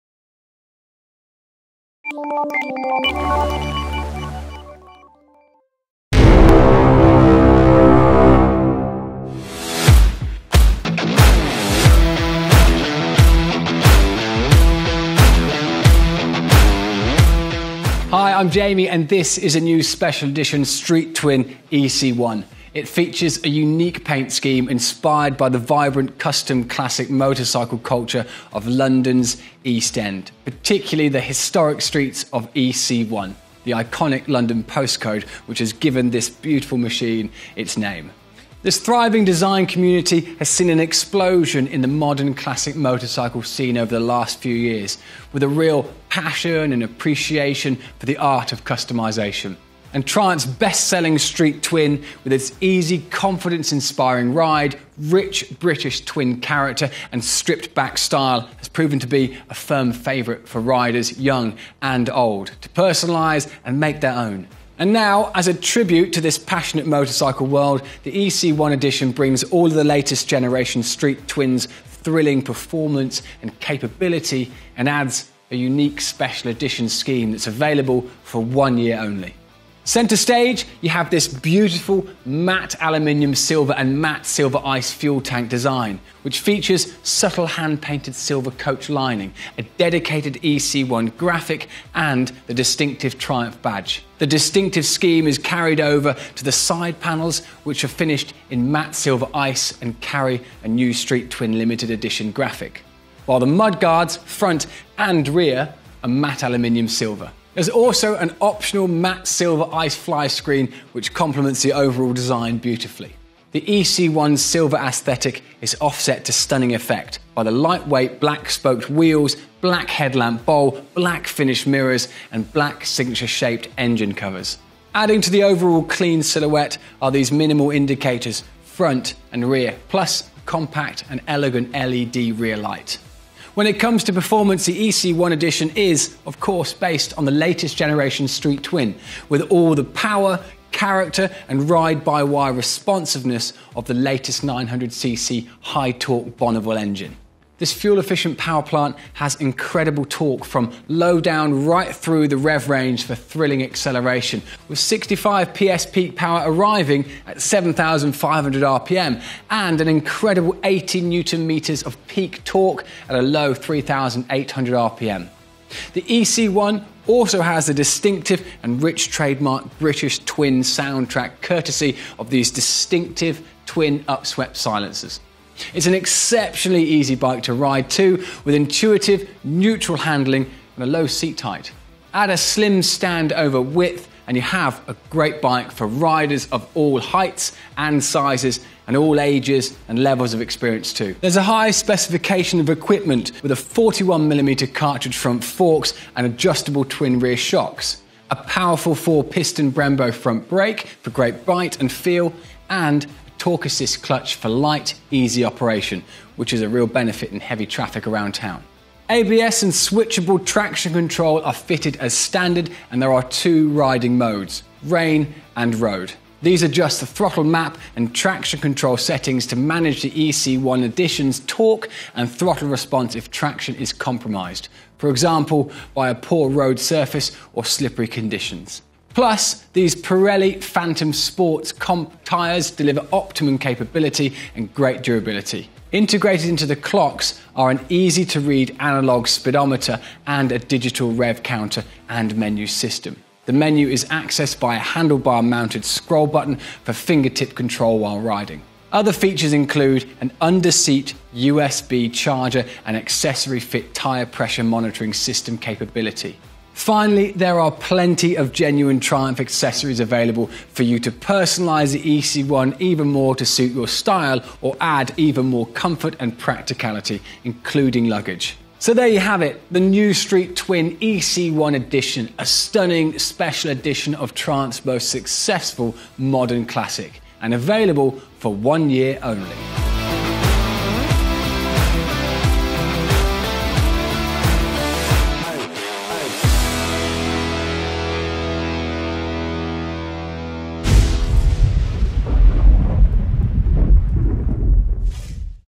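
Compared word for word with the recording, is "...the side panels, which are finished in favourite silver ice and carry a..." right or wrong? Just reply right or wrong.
wrong.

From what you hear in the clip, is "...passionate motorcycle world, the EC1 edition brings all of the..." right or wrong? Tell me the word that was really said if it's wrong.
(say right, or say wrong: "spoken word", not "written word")
right.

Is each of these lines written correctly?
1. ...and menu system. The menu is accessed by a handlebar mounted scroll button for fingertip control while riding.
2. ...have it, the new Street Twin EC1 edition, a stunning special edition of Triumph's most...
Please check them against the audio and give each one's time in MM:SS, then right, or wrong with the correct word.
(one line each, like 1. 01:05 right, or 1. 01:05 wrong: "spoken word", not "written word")
1. 04:02 right
2. 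04:29 right.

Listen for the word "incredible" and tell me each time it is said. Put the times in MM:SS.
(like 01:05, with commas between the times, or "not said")
02:29, 02:39.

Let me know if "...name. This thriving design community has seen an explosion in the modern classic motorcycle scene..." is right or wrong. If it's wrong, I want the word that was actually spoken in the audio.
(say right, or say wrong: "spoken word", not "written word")
right.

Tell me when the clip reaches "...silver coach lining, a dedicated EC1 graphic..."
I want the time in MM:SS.
01:28.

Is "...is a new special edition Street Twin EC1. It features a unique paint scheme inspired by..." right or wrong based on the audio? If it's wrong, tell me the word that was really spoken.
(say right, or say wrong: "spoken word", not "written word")
right.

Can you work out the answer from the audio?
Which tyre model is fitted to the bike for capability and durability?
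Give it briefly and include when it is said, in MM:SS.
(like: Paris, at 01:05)
Pirelli Phantom Sports Comp, at 03:49.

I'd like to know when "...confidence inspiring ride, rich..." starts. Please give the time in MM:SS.
00:53.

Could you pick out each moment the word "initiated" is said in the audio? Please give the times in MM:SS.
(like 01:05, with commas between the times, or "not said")
not said.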